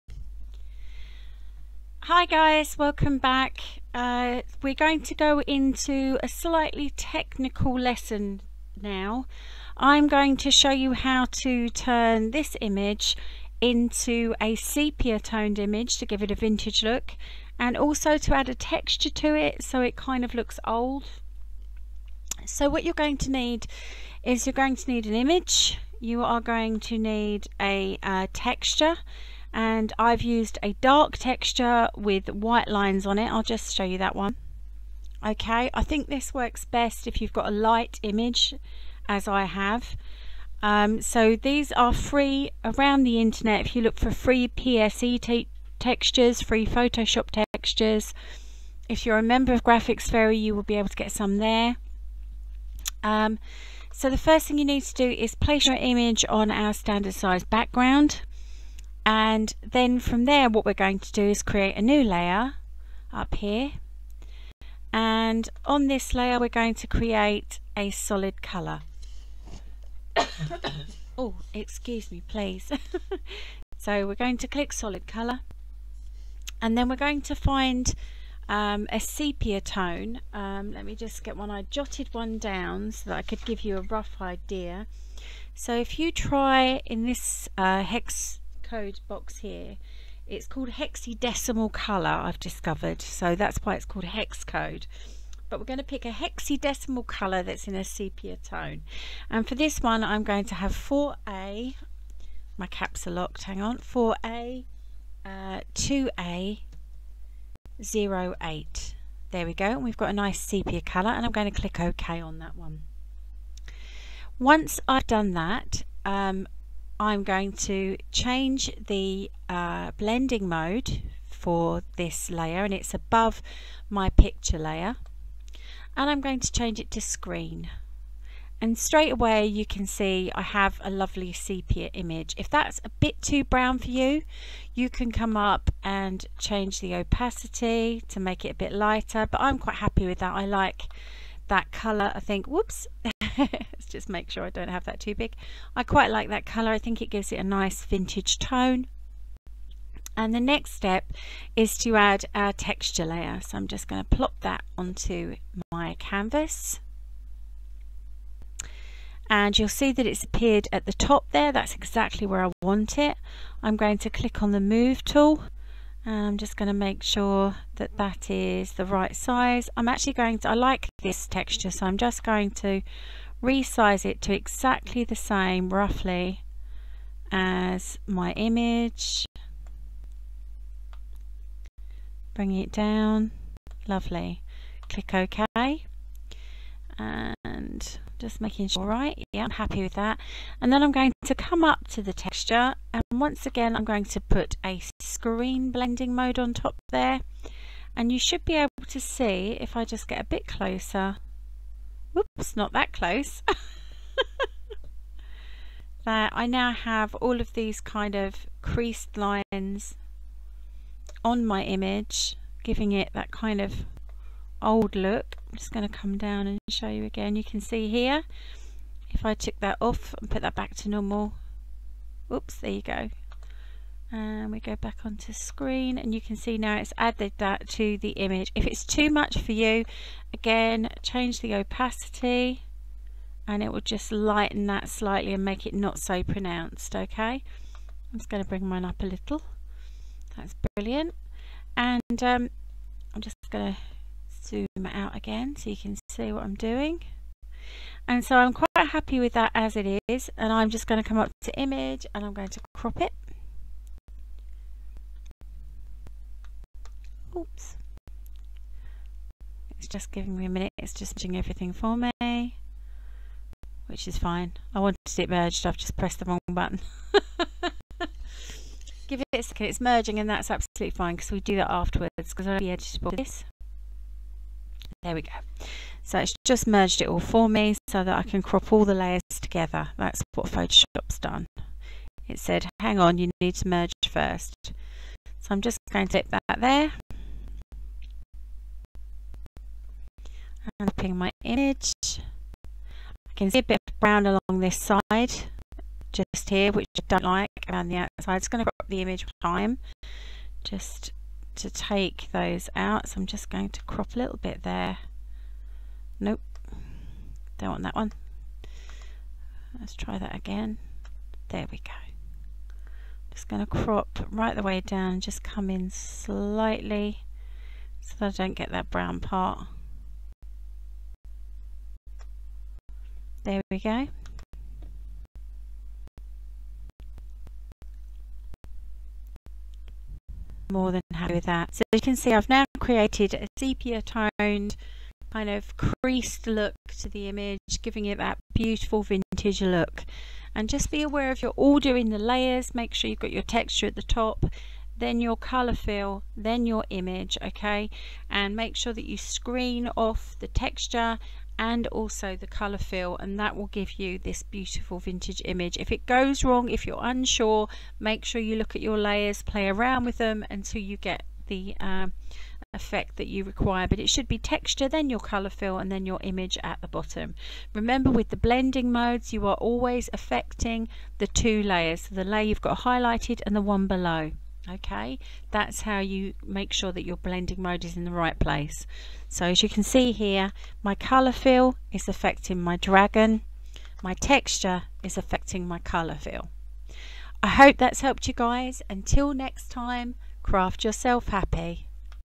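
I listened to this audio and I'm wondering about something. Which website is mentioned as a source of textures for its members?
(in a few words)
Graphics Fairy.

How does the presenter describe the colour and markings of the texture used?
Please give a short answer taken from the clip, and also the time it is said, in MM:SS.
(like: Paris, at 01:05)
Dark texture with white lines, at 00:30.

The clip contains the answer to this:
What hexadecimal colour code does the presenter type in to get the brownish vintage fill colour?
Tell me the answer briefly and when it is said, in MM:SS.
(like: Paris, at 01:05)
4A2A08, at 01:43.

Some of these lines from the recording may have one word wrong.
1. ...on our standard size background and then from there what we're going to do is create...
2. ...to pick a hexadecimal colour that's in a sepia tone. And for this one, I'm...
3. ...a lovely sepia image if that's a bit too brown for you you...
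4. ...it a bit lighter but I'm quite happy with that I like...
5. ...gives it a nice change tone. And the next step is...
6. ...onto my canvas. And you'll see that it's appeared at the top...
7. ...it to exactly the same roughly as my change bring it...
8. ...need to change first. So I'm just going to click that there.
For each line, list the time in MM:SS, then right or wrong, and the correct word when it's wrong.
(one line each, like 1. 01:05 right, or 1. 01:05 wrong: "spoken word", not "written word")
1. 00:56 right
2. 01:35 right
3. 02:10 right
4. 02:18 right
5. 02:27 wrong: "vintage", not "change"
6. 02:34 right
7. 02:54 wrong: "image", not "change"
8. 04:43 wrong: "merge", not "change".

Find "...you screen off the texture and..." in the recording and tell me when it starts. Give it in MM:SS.
05:49.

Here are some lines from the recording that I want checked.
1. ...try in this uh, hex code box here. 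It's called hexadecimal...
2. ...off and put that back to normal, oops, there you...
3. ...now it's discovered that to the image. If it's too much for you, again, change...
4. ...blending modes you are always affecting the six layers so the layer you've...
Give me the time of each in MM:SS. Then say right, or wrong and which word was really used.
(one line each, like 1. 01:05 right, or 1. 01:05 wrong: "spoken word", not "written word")
1. 01:26 right
2. 03:39 right
3. 03:46 wrong: "added", not "discovered"
4. 06:08 wrong: "two", not "six".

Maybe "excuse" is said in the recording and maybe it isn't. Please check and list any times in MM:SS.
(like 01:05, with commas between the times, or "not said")
01:11.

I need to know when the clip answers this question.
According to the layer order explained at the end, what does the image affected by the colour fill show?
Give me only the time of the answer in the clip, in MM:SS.
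06:22.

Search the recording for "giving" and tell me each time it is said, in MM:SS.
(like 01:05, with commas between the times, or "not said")
03:32, 04:20, 05:37.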